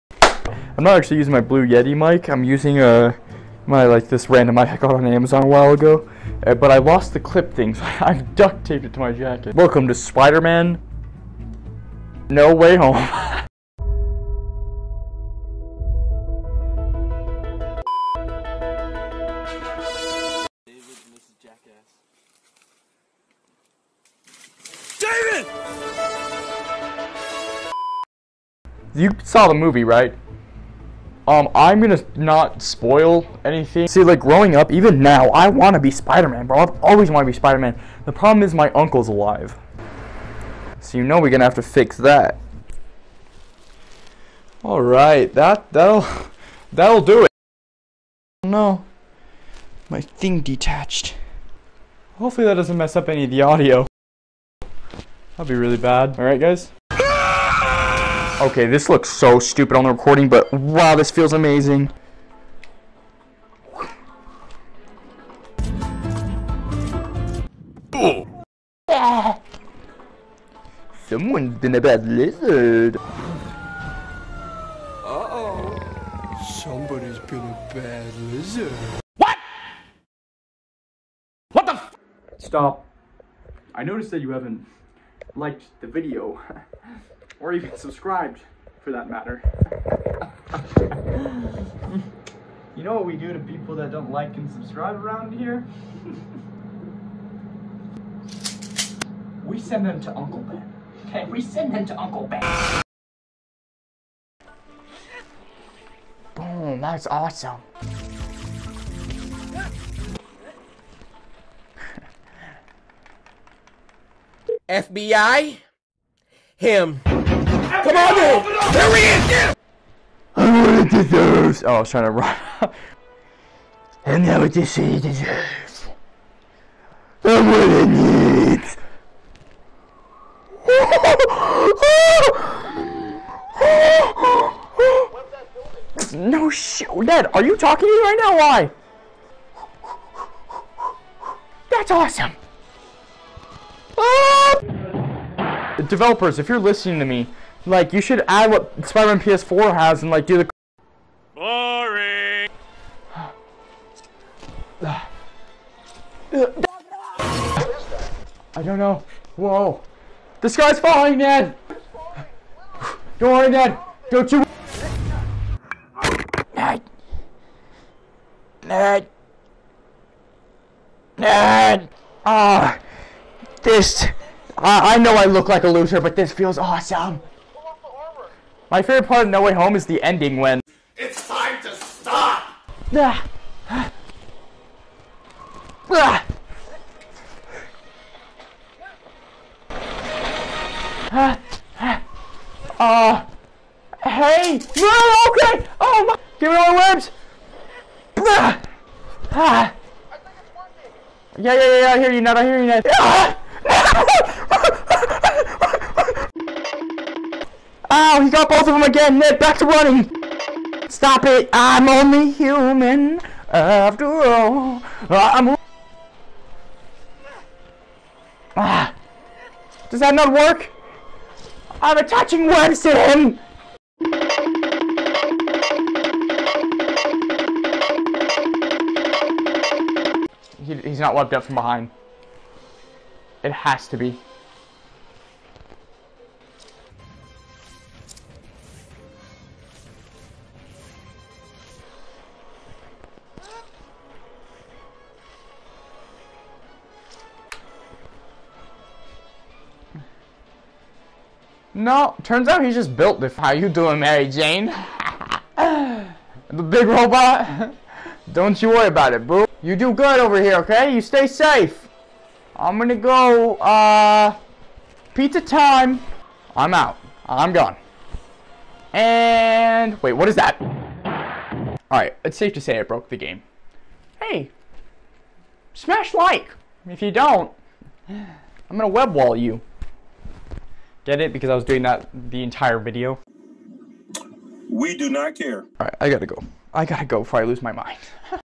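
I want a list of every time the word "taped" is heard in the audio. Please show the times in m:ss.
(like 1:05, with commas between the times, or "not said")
0:08.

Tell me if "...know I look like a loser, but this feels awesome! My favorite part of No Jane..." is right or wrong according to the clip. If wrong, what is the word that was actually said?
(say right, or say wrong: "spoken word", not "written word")
wrong: "Way", not "Jane".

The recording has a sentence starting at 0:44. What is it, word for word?
All right, that that'll that'll do it.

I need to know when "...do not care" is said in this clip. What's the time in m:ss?
4:44.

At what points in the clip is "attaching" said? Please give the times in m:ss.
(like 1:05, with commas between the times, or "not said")
3:41.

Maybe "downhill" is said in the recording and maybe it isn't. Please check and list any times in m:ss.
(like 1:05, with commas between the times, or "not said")
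not said.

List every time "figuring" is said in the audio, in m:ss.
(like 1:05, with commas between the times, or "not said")
not said.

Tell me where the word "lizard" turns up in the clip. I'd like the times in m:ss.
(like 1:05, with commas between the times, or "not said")
1:12, 1:18.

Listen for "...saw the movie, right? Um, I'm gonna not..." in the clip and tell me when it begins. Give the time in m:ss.
0:29.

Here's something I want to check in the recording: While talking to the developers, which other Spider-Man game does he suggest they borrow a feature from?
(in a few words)
Spider-Man PS4.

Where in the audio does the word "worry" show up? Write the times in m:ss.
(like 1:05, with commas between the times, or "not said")
2:43, 4:18.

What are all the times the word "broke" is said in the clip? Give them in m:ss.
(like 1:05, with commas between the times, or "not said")
4:32.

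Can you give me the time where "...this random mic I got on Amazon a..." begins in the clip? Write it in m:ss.
0:04.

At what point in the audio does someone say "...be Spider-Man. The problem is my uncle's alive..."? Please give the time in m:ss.
0:37.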